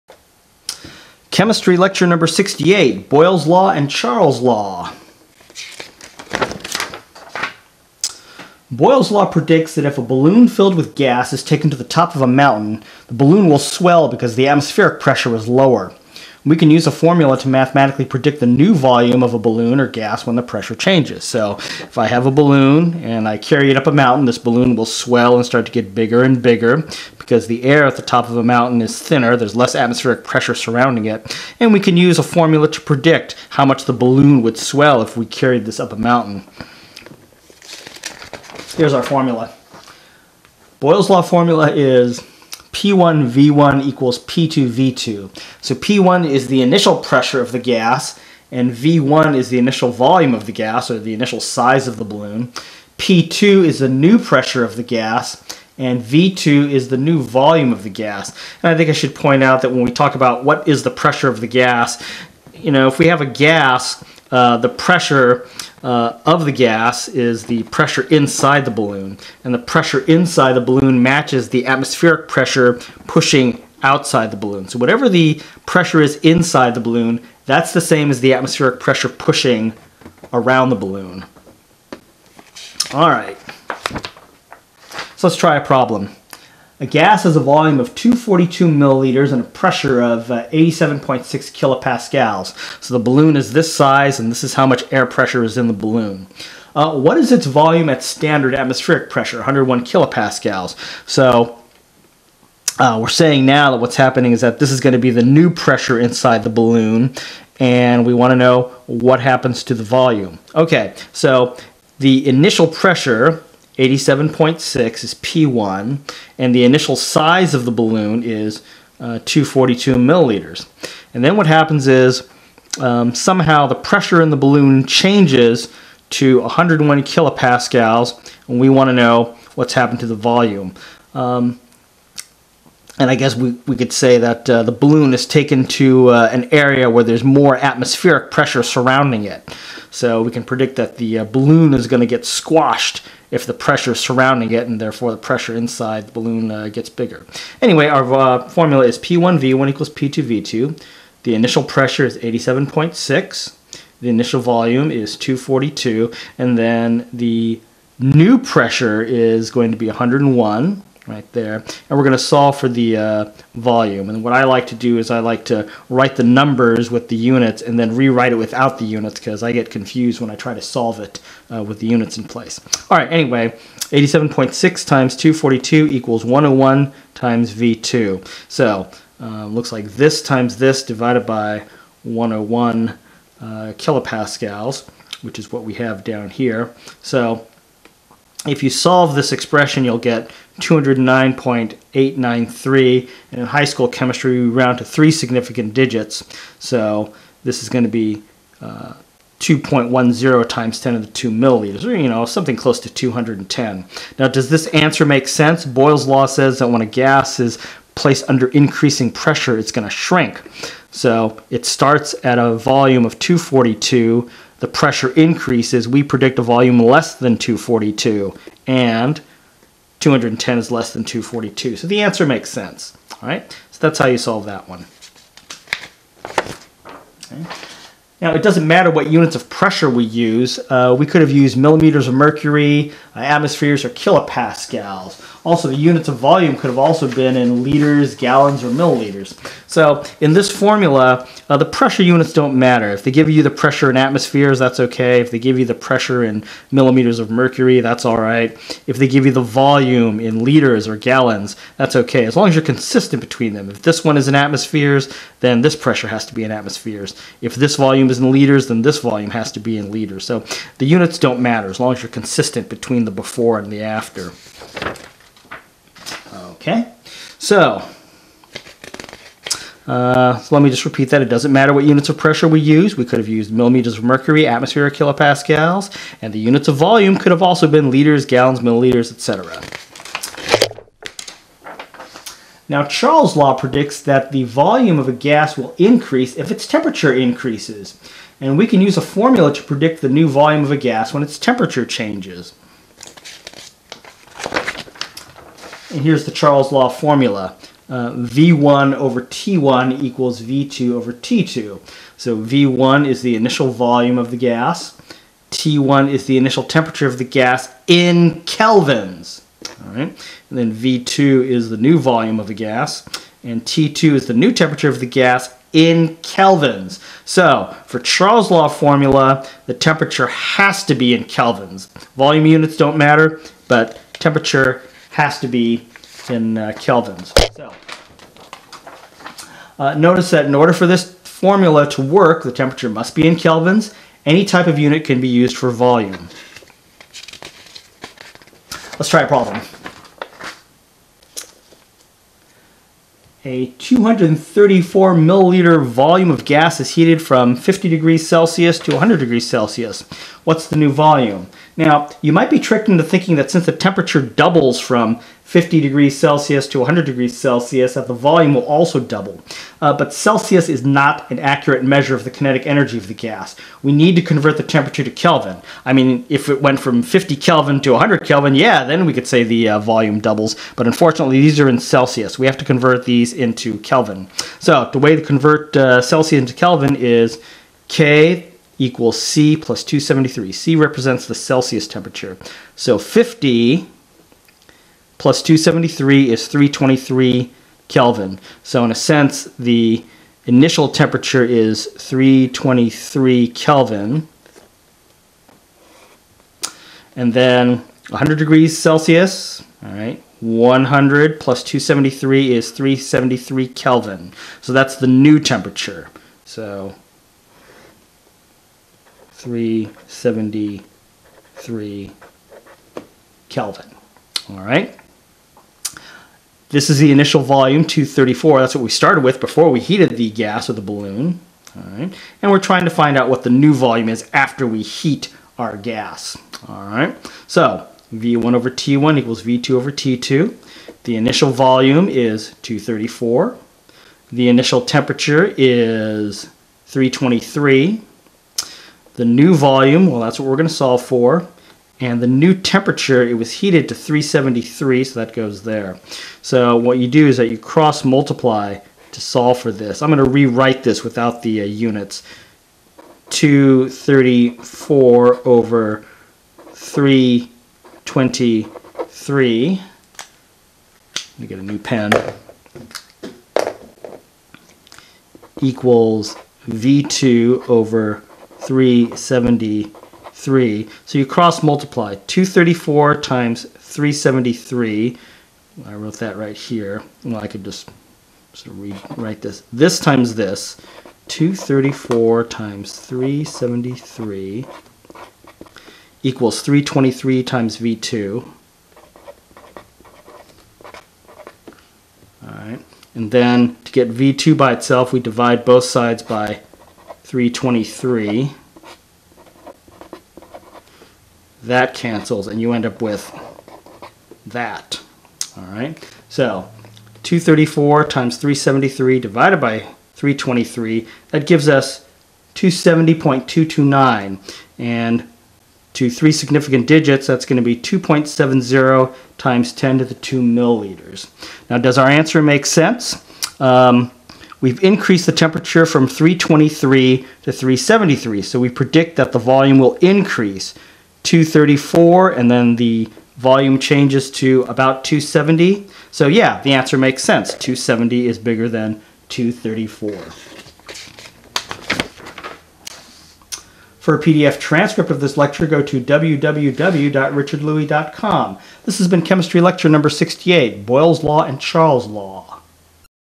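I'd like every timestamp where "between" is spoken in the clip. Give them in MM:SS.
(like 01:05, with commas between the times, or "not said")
04:13, 04:22.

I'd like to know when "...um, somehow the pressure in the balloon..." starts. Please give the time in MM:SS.
02:02.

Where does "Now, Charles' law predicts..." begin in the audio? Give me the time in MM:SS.
04:42.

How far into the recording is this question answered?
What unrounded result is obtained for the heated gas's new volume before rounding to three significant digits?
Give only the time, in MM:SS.
08:32.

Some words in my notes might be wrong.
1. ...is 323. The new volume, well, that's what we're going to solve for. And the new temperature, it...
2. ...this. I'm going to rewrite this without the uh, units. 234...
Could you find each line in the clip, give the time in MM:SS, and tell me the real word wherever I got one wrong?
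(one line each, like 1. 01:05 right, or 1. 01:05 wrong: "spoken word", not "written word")
1. 07:15 right
2. 07:29 right.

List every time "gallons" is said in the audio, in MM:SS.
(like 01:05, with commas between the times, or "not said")
03:58, 04:10, 04:38.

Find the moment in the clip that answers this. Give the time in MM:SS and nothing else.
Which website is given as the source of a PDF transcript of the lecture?
09:05.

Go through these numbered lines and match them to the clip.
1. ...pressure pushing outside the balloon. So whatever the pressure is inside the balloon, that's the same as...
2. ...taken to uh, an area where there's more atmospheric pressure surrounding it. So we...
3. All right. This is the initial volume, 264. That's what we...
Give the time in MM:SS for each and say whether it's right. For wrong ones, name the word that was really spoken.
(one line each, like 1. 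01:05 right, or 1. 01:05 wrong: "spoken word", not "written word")
1. 01:12 right
2. 02:15 right
3. 06:54 wrong: "234", not "264".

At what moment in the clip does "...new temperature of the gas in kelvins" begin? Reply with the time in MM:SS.
05:14.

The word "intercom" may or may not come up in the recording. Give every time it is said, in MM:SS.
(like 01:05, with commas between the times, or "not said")
not said.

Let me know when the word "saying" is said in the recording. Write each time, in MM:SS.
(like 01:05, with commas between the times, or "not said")
01:43.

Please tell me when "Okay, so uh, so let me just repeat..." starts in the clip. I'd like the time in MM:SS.
04:26.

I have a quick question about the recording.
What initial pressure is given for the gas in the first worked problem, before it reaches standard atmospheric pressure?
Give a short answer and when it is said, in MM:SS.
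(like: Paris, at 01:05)
87.6 kilopascals, at 01:30.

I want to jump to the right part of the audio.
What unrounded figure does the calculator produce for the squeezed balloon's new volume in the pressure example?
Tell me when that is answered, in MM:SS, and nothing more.
03:10.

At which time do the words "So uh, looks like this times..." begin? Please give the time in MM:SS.
02:58.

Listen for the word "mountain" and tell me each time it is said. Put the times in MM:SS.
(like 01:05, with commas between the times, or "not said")
00:12, 00:23, 00:28, 00:35.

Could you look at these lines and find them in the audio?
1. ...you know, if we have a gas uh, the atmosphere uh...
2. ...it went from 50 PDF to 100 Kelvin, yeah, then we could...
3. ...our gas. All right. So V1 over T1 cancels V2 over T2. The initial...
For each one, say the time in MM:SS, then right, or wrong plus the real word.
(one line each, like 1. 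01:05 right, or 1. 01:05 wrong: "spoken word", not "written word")
1. 01:02 wrong: "pressure", not "atmosphere"
2. 06:06 wrong: "Kelvin", not "PDF"
3. 07:05 wrong: "equals", not "cancels".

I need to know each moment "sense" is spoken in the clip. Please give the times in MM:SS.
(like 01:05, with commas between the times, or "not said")
03:25, 03:42, 06:28, 08:42, 08:57.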